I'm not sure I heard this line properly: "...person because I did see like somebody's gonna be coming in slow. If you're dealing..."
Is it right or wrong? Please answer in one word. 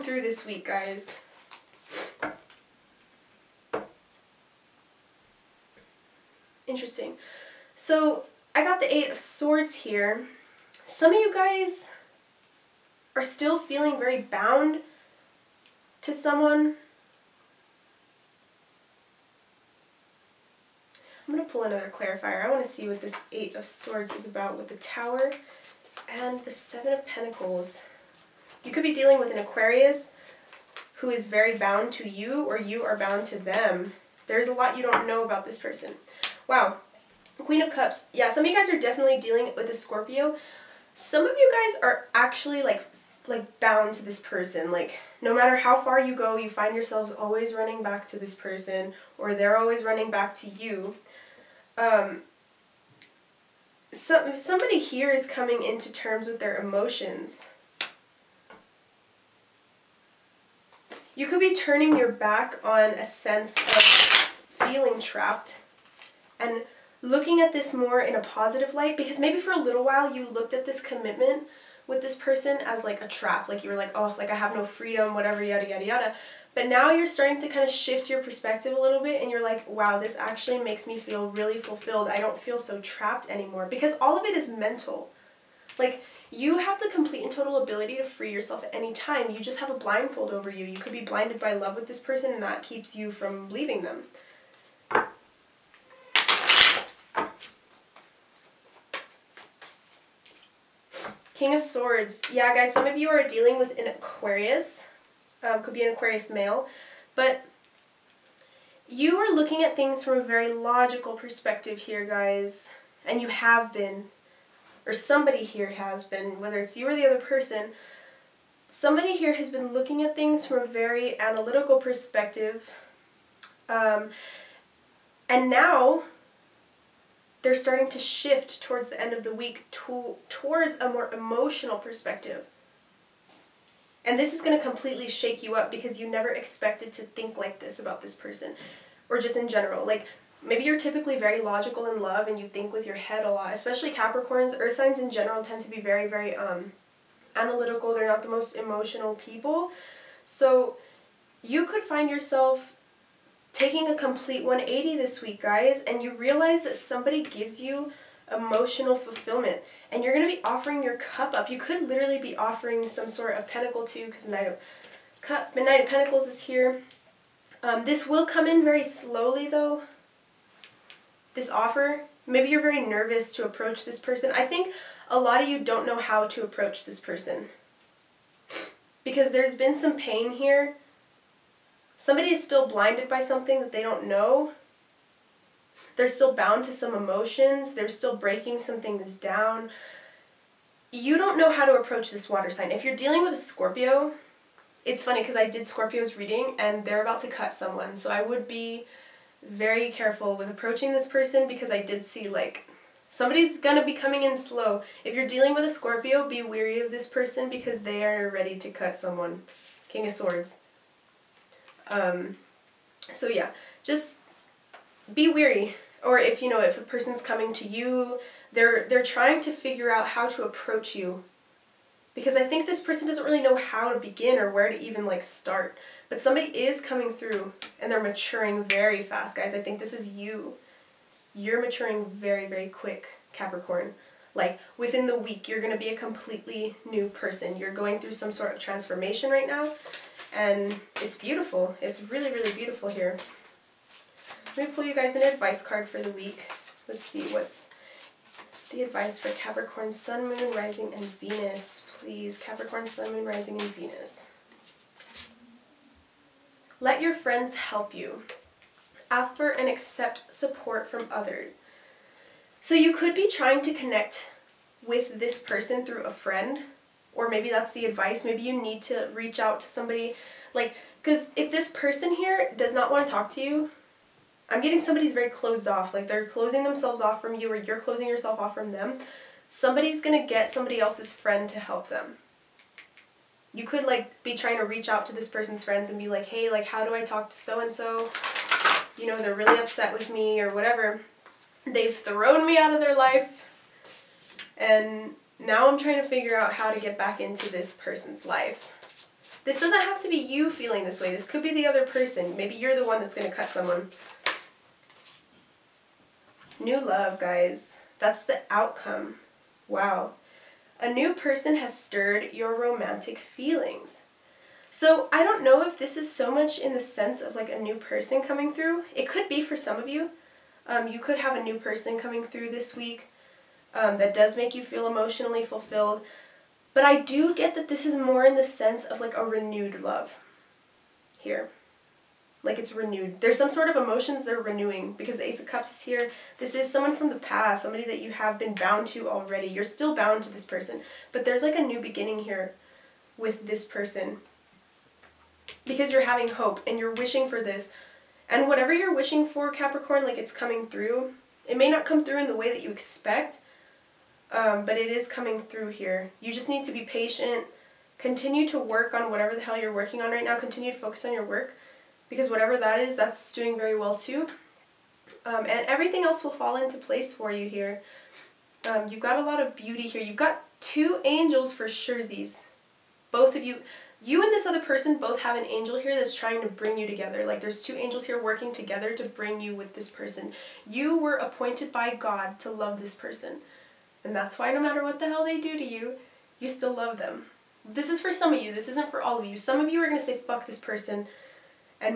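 right.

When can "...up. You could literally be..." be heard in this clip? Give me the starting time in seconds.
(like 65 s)
161 s.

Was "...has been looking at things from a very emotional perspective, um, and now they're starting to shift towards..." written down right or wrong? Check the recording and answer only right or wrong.
wrong.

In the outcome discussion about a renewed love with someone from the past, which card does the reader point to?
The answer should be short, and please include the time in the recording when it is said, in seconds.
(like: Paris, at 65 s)
Ace of Cups, at 335 s.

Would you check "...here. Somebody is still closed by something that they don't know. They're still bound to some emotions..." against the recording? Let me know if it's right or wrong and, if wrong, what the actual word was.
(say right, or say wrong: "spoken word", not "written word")
wrong: "blinded", not "closed".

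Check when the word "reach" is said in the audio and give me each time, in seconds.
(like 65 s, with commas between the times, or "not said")
269 s, 284 s.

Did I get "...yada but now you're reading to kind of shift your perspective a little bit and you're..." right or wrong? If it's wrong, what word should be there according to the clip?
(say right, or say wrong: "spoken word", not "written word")
wrong: "starting", not "reading".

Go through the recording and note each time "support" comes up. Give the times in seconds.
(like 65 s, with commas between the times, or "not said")
260 s.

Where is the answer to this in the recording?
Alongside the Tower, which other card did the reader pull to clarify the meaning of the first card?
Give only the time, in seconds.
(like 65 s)
26 s.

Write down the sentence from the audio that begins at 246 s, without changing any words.
Let's see what's the advice for Capricorn, Sun, Moon, Rising, and Venus.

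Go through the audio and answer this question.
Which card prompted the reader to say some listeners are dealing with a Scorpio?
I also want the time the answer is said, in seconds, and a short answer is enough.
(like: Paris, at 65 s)
Queen of Cups, at 37 s.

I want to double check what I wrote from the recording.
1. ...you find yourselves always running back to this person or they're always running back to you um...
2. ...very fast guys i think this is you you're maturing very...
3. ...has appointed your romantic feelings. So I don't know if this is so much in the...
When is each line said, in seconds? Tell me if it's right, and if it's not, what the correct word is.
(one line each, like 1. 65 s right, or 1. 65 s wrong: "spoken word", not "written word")
1. 46 s right
2. 228 s right
3. 311 s wrong: "stirred", not "appointed".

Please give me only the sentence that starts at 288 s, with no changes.
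You know, they're really upset with me or whatever.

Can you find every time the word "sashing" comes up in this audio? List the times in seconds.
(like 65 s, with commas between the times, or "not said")
not said.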